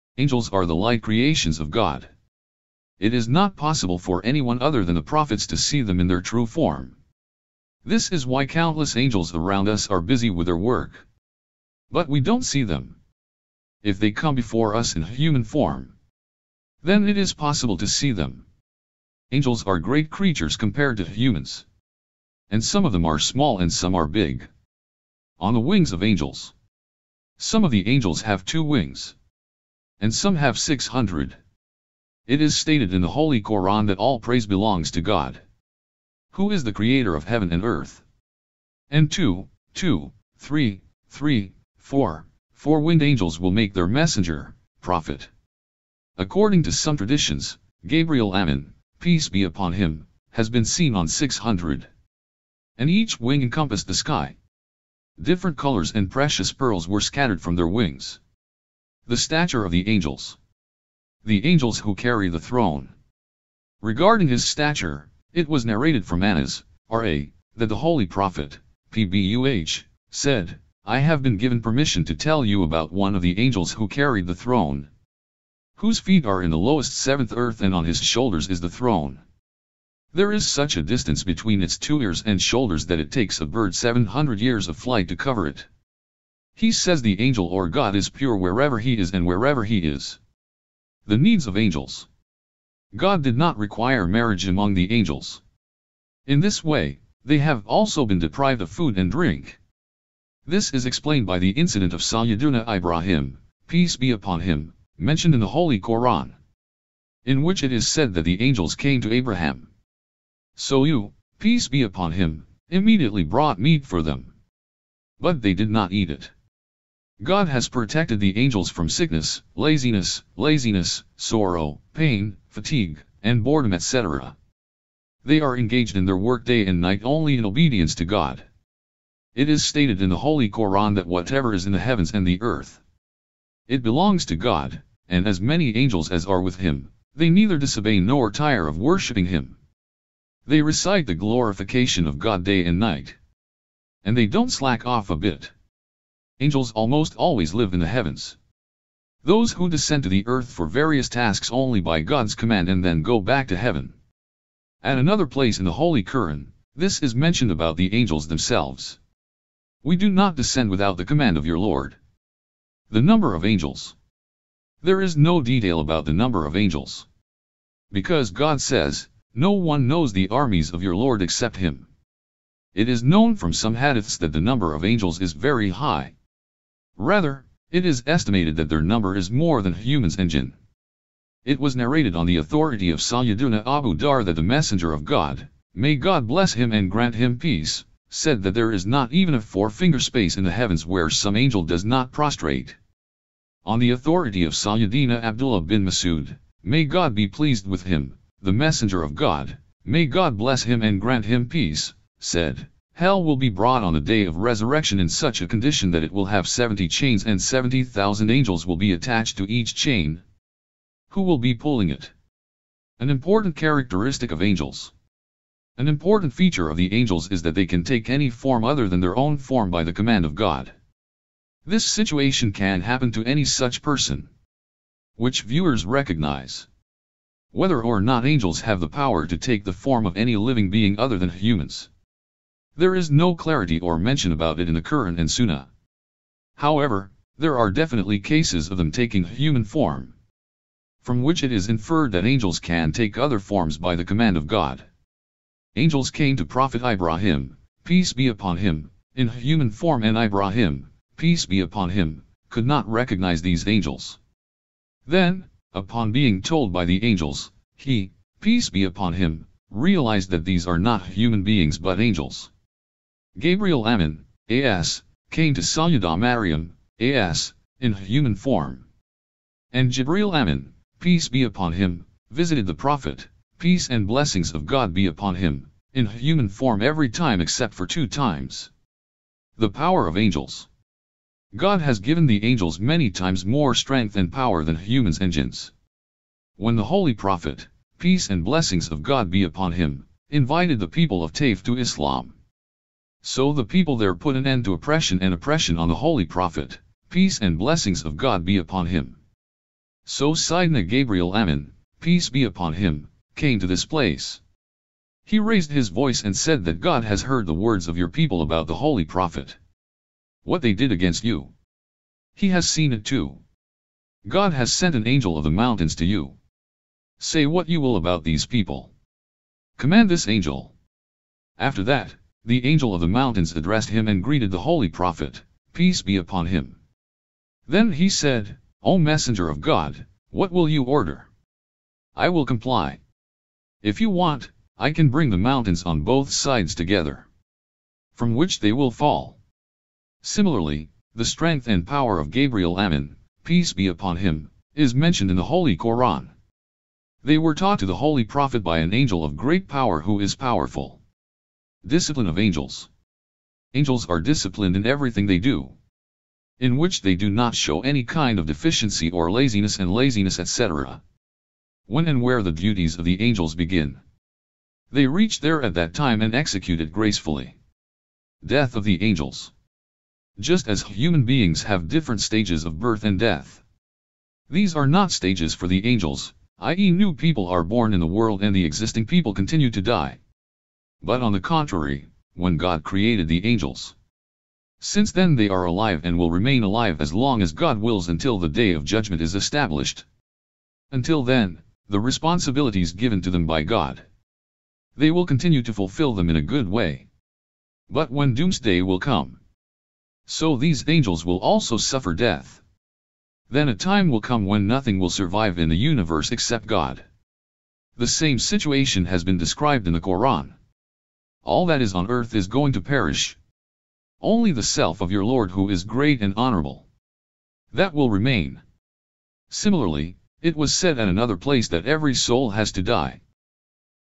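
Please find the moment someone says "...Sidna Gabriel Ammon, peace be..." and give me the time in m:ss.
5:00.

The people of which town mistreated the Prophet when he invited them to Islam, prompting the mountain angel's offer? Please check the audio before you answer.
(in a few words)
Taif.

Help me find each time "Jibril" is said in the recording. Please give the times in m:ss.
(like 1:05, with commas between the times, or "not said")
4:29.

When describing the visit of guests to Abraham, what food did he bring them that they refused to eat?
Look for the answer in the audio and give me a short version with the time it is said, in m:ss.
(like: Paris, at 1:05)
meat, at 1:53.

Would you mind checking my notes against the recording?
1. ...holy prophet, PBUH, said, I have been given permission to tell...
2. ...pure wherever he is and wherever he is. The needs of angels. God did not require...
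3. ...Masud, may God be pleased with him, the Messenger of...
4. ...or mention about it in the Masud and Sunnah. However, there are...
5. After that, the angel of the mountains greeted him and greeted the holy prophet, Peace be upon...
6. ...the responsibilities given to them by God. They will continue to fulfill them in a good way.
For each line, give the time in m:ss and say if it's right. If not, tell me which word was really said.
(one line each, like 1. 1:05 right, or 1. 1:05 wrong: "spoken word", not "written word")
1. 1:07 right
2. 1:28 right
3. 3:15 right
4. 3:53 wrong: "Quran", not "Masud"
5. 5:21 wrong: "addressed", not "greeted"
6. 6:31 right.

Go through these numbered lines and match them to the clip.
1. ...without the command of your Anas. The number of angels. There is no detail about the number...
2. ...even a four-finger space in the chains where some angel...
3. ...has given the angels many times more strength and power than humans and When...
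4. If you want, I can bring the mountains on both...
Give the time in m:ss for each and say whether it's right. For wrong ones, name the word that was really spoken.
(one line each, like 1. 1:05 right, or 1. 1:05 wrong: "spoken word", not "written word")
1. 2:40 wrong: "Lord", not "Anas"
2. 3:09 wrong: "heavens", not "chains"
3. 4:41 right
4. 5:33 right.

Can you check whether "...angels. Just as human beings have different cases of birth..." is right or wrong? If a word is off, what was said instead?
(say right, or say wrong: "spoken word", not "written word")
wrong: "stages", not "cases".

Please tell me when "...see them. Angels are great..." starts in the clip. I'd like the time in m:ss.
0:17.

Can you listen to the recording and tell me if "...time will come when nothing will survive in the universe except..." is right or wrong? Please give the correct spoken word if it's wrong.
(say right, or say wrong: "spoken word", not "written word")
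right.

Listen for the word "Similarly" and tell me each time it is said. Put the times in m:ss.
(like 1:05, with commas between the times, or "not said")
5:40, 6:59.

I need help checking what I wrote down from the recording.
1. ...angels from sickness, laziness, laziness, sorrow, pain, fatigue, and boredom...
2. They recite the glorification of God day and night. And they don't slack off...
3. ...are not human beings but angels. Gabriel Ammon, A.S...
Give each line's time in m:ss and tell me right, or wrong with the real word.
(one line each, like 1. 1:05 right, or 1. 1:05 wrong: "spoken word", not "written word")
1. 1:58 right
2. 2:20 right
3. 4:20 right.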